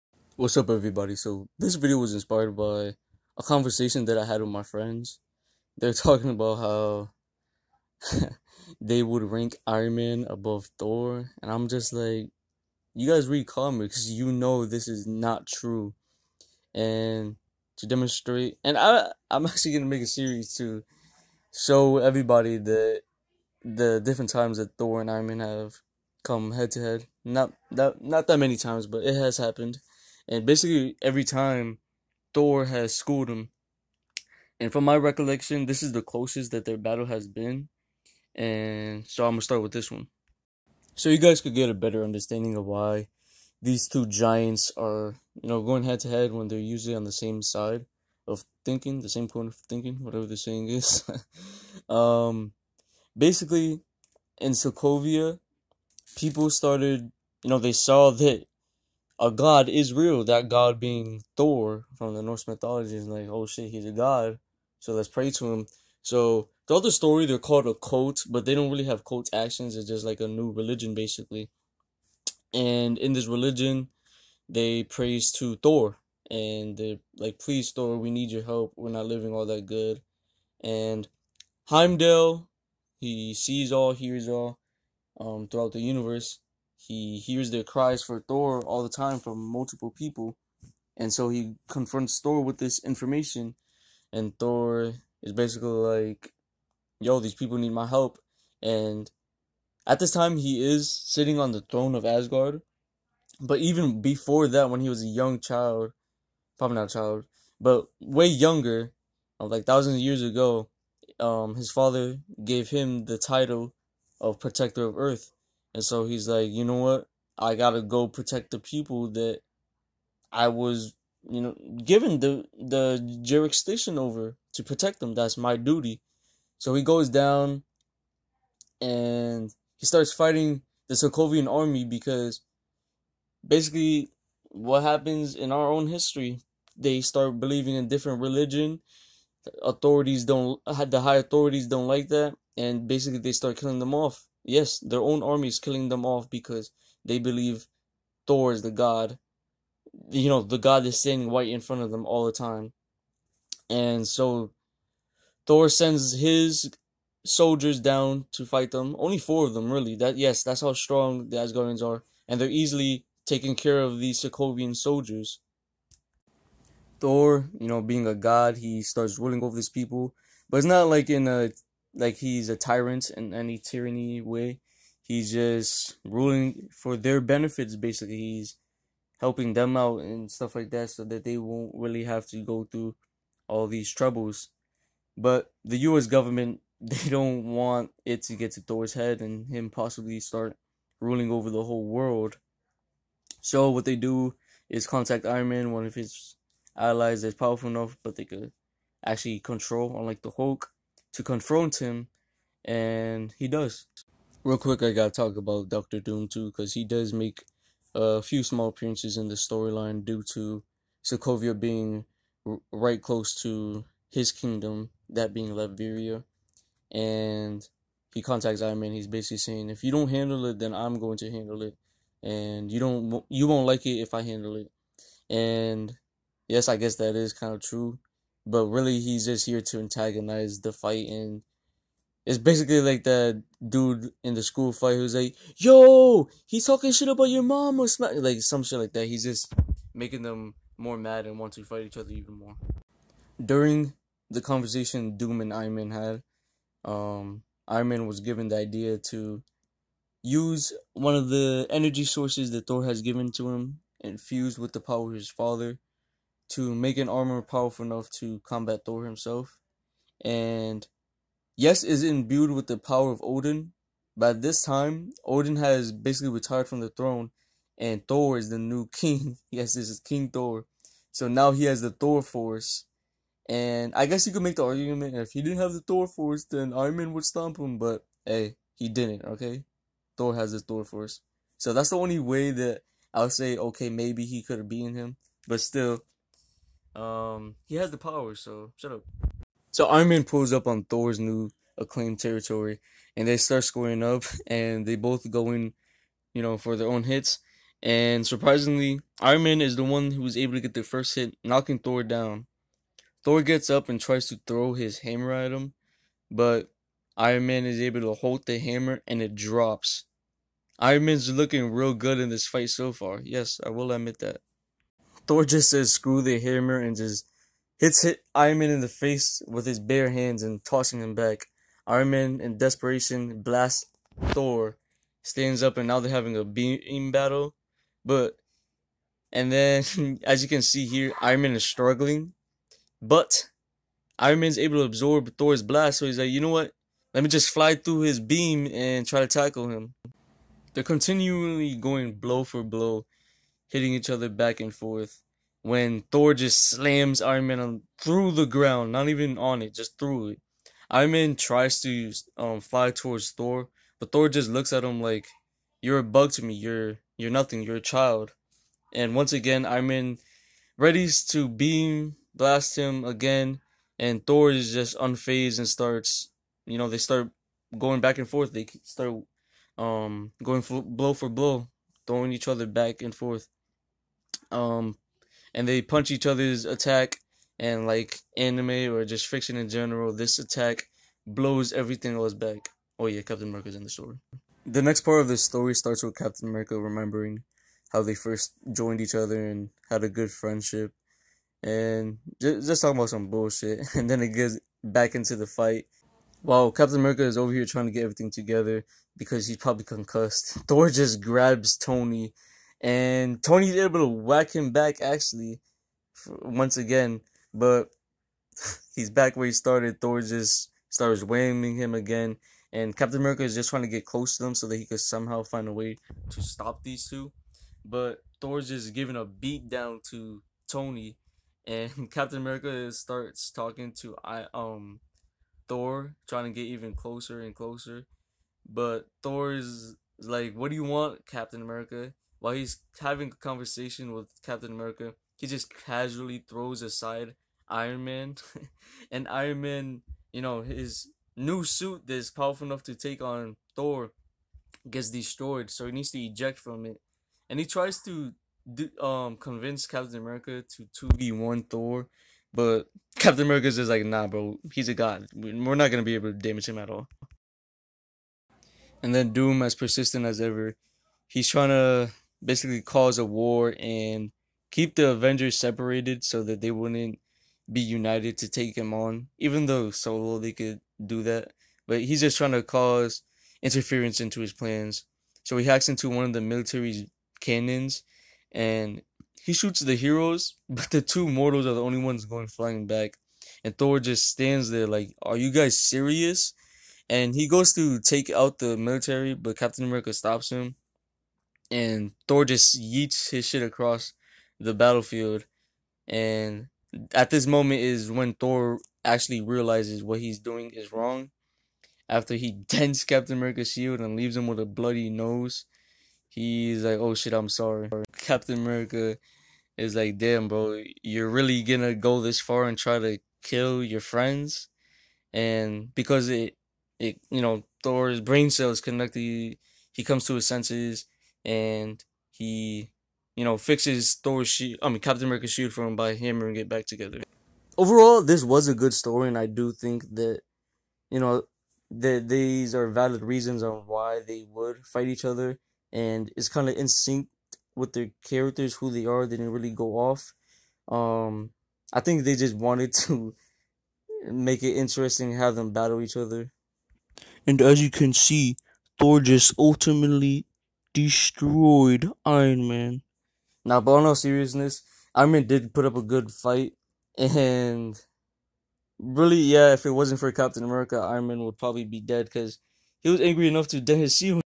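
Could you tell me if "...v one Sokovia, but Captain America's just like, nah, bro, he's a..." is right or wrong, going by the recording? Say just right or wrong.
wrong.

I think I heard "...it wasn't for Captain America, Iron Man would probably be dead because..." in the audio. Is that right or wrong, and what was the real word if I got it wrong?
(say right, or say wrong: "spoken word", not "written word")
right.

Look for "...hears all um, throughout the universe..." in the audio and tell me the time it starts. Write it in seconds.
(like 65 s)
83 s.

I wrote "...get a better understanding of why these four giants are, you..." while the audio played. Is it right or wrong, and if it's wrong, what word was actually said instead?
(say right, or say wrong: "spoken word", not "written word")
wrong: "two", not "four".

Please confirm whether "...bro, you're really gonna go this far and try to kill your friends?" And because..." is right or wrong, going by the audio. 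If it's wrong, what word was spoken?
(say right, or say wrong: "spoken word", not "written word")
right.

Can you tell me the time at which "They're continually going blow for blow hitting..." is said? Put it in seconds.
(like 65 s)
340 s.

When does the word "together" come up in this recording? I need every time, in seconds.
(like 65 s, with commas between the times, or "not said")
398 s, 526 s.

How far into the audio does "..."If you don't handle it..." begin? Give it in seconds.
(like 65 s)
219 s.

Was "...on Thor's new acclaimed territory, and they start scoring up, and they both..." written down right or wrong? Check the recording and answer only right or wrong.
right.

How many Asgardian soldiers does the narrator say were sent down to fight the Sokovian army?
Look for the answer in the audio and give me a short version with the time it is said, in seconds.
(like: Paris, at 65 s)
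4, at 159 s.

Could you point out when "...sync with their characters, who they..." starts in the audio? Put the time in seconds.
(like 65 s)
536 s.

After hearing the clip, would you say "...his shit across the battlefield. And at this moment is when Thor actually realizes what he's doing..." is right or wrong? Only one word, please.
right.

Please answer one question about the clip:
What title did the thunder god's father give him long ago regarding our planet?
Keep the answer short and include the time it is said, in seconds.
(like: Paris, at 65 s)
Protector of Earth, at 114 s.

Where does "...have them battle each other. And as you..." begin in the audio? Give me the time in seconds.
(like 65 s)
545 s.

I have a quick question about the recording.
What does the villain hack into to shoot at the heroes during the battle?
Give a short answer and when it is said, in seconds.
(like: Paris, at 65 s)
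military's cannons, at 476 s.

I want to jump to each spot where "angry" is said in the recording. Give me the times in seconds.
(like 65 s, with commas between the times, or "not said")
563 s.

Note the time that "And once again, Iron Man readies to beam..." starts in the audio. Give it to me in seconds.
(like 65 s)
358 s.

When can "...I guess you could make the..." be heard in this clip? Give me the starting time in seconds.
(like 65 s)
273 s.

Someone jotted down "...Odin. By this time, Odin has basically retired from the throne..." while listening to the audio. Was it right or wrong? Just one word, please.
right.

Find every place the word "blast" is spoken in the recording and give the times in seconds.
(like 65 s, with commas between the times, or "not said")
323 s, 335 s, 362 s.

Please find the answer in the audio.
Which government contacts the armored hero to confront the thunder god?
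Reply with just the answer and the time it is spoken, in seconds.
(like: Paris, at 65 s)
US government, at 185 s.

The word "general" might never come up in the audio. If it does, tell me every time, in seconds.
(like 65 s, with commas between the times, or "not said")
379 s.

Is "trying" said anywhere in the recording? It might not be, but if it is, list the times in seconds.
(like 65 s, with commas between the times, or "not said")
397 s, 413 s, 426 s, 461 s, 472 s.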